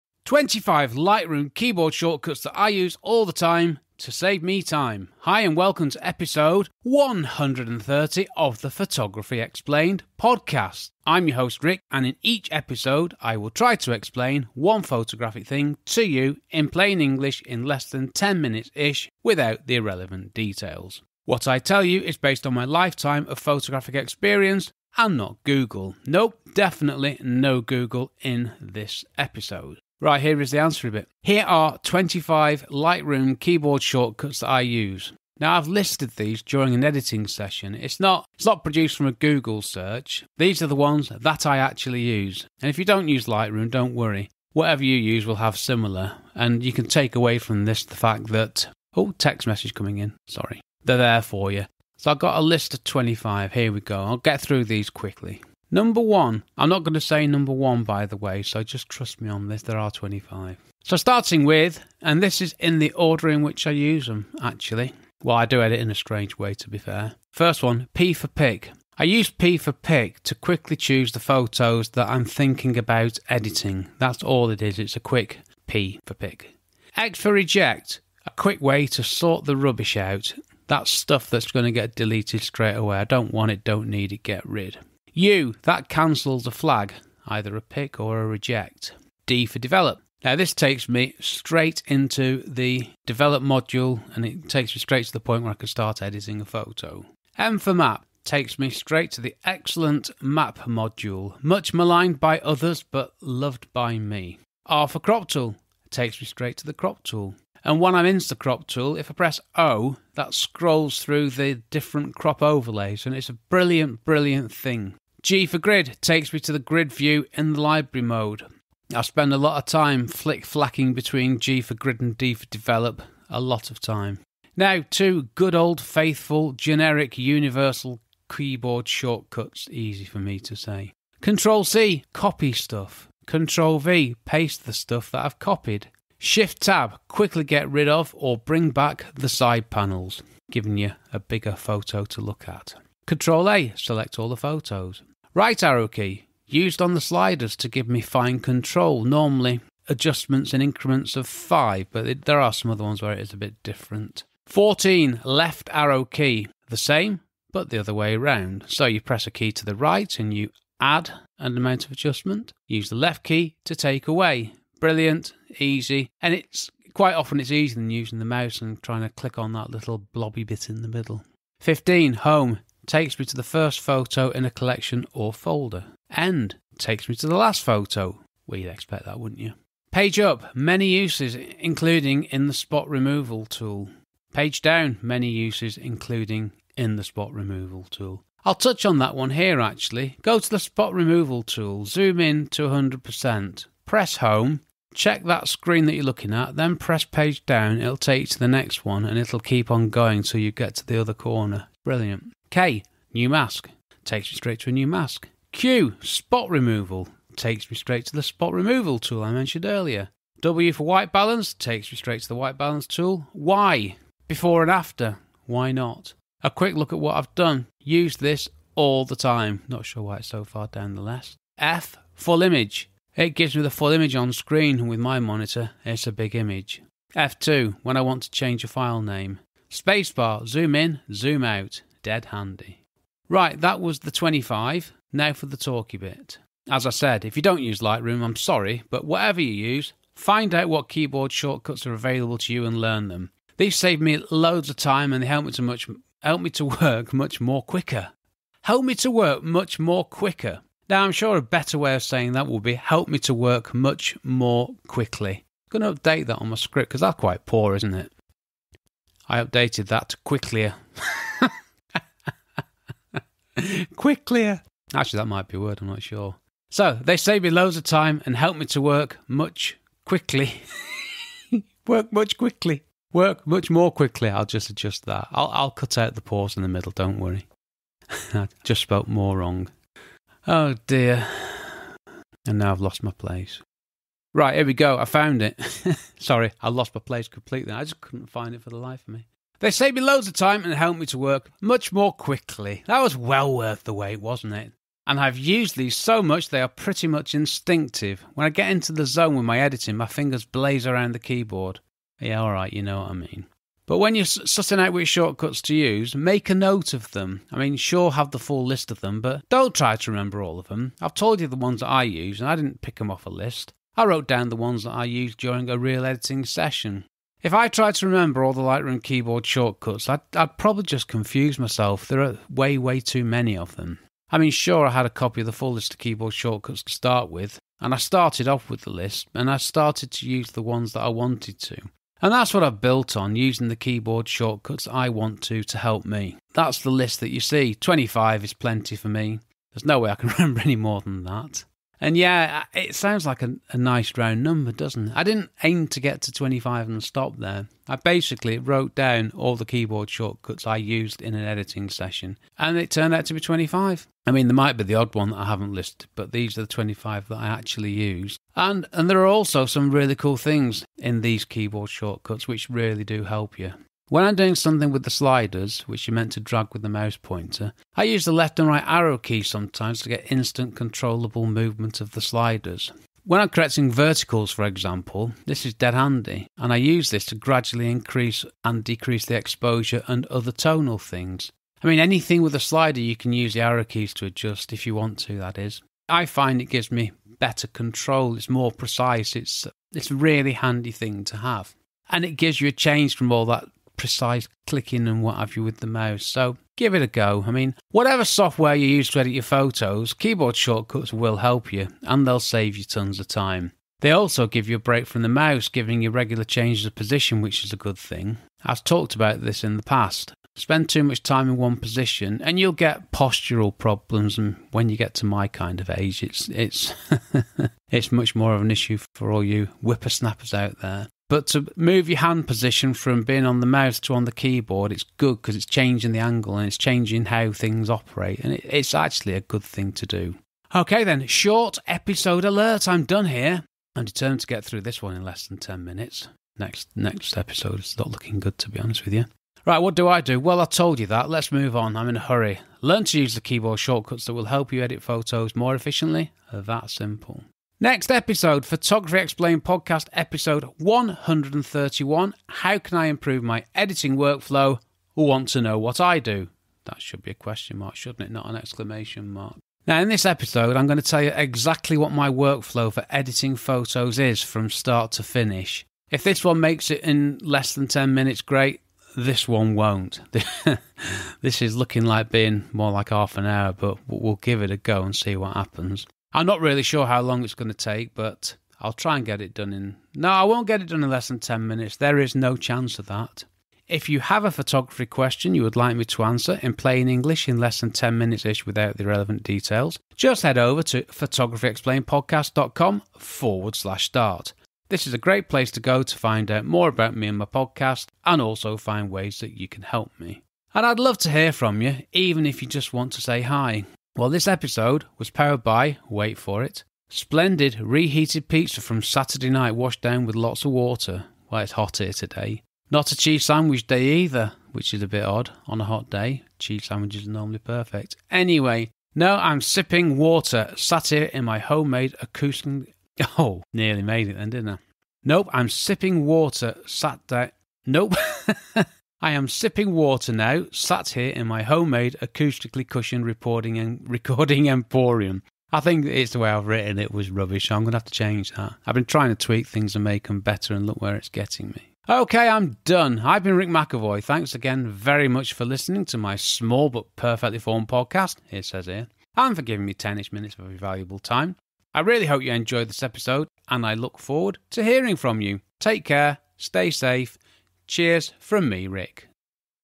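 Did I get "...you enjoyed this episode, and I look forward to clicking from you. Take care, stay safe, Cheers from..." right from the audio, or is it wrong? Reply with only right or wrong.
wrong.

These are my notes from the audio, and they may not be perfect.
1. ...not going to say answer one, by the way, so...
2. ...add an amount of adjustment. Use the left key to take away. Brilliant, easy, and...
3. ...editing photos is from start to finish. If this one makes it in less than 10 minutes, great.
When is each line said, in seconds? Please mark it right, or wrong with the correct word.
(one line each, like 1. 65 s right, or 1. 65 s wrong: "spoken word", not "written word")
1. 56 s wrong: "number", not "answer"
2. 160 s right
3. 463 s right.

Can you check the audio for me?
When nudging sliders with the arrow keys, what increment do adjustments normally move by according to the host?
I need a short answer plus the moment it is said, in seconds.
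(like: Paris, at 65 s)
5, at 151 s.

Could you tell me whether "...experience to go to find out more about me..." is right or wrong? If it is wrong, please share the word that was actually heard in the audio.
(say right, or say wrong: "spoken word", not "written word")
wrong: "place", not "experience".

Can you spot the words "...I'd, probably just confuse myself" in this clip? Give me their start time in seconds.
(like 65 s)
320 s.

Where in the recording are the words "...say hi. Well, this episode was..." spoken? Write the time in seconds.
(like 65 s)
503 s.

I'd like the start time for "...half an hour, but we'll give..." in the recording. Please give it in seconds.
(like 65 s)
473 s.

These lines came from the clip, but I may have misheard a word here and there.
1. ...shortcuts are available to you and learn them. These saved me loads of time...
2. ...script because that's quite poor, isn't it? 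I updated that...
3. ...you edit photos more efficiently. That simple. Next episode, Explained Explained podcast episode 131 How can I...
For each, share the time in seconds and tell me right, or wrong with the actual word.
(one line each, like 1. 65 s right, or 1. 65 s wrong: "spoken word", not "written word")
1. 241 s right
2. 256 s right
3. 444 s wrong: "Photography", not "Explained".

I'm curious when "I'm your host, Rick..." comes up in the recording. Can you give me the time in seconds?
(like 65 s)
11 s.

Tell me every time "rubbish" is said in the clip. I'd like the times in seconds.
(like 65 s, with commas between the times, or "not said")
79 s, 537 s.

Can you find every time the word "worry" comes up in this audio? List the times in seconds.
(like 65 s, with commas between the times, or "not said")
43 s, 277 s.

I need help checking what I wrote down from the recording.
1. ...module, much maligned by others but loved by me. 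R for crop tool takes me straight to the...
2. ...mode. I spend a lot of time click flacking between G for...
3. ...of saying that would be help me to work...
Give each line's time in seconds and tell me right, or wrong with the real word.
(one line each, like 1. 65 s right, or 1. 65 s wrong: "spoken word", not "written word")
1. 100 s right
2. 118 s wrong: "flick", not "click"
3. 251 s right.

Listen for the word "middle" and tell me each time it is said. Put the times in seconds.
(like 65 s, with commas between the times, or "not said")
170 s, 276 s.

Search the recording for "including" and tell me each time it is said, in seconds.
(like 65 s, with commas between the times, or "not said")
181 s, 185 s.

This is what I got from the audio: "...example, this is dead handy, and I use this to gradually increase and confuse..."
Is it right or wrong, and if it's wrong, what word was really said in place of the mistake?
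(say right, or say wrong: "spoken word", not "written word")
wrong: "decrease", not "confuse".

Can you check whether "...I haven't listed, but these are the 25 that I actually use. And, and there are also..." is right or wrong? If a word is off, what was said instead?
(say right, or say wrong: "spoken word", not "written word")
right.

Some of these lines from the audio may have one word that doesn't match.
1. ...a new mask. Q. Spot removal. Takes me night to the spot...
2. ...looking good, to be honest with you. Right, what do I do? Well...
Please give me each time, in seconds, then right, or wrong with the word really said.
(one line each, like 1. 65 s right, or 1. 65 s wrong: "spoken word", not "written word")
1. 204 s wrong: "straight", not "night"
2. 438 s right.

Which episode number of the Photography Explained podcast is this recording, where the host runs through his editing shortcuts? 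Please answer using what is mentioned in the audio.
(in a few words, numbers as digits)
130.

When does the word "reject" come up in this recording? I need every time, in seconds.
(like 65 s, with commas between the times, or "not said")
77 s, 88 s.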